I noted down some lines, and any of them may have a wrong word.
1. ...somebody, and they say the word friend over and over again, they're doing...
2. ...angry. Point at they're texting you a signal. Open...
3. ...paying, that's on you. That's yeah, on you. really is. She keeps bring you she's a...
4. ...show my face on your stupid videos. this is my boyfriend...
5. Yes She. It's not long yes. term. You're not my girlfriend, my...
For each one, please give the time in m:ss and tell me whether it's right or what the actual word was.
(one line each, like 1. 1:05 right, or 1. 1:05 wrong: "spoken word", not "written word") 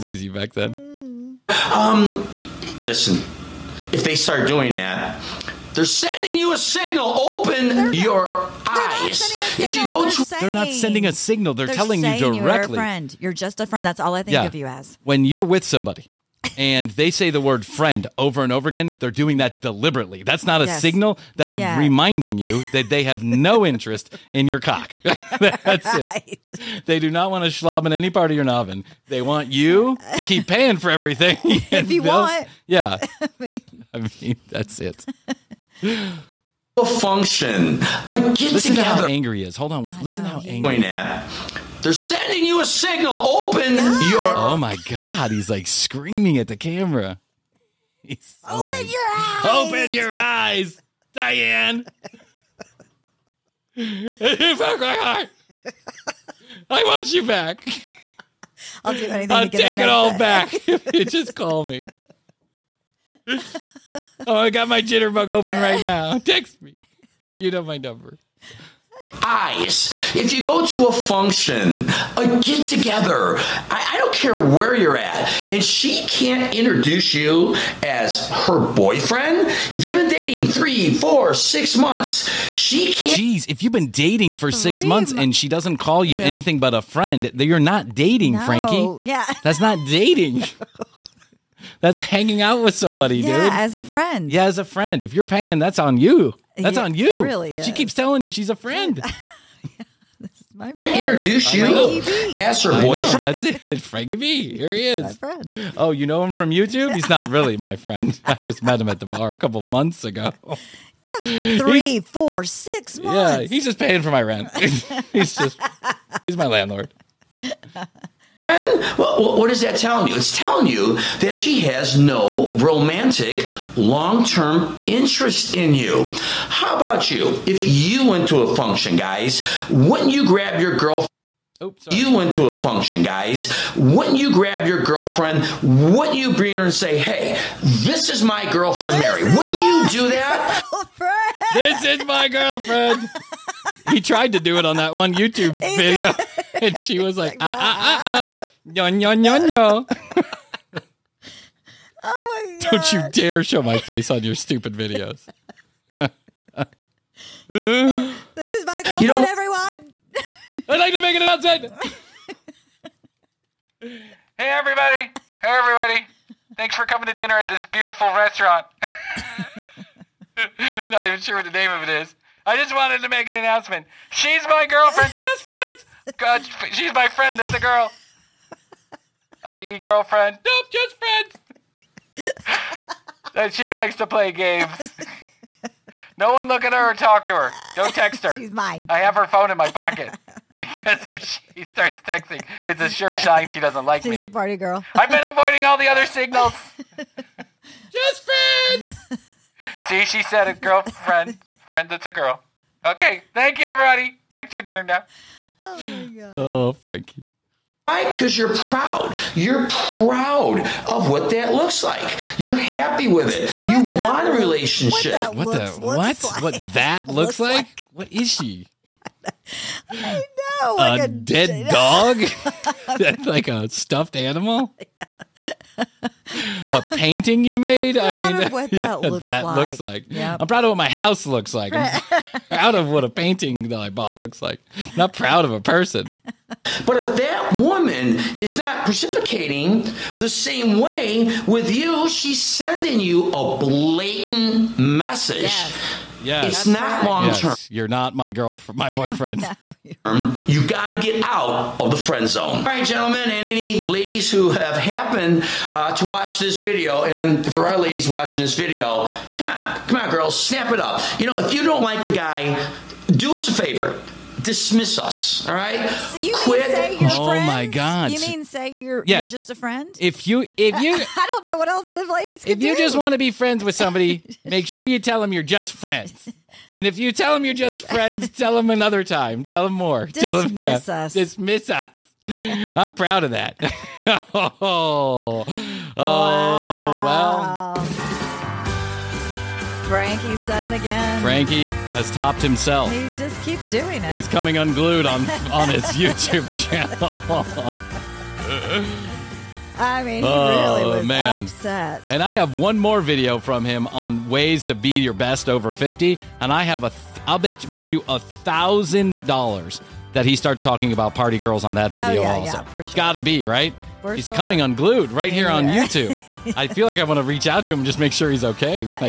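1. 0:15 right
2. 0:40 wrong: "sending", not "texting"
3. 1:35 wrong: "telling", not "bring"
4. 2:33 wrong: "girlfriend", not "boyfriend"
5. 4:05 wrong: "Yes", not "She".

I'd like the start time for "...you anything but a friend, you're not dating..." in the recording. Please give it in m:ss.
1:26.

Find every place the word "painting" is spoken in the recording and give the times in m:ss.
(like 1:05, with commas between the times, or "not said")
3:46, 3:53.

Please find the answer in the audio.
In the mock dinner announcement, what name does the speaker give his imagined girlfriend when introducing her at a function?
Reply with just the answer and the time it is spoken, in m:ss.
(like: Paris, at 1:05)
Mary, at 2:19.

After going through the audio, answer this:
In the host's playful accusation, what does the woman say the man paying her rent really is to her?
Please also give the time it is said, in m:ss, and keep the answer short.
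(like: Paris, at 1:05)
landlord, at 1:56.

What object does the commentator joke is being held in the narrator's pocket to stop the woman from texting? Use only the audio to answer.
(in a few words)
her phone.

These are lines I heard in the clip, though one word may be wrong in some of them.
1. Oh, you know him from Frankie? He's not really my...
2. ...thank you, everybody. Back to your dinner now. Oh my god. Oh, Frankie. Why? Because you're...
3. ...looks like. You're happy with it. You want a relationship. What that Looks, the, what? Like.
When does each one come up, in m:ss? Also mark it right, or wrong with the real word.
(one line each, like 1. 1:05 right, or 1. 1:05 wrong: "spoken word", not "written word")
1. 1:45 wrong: "YouTube", not "Frankie"
2. 3:23 right
3. 3:31 right.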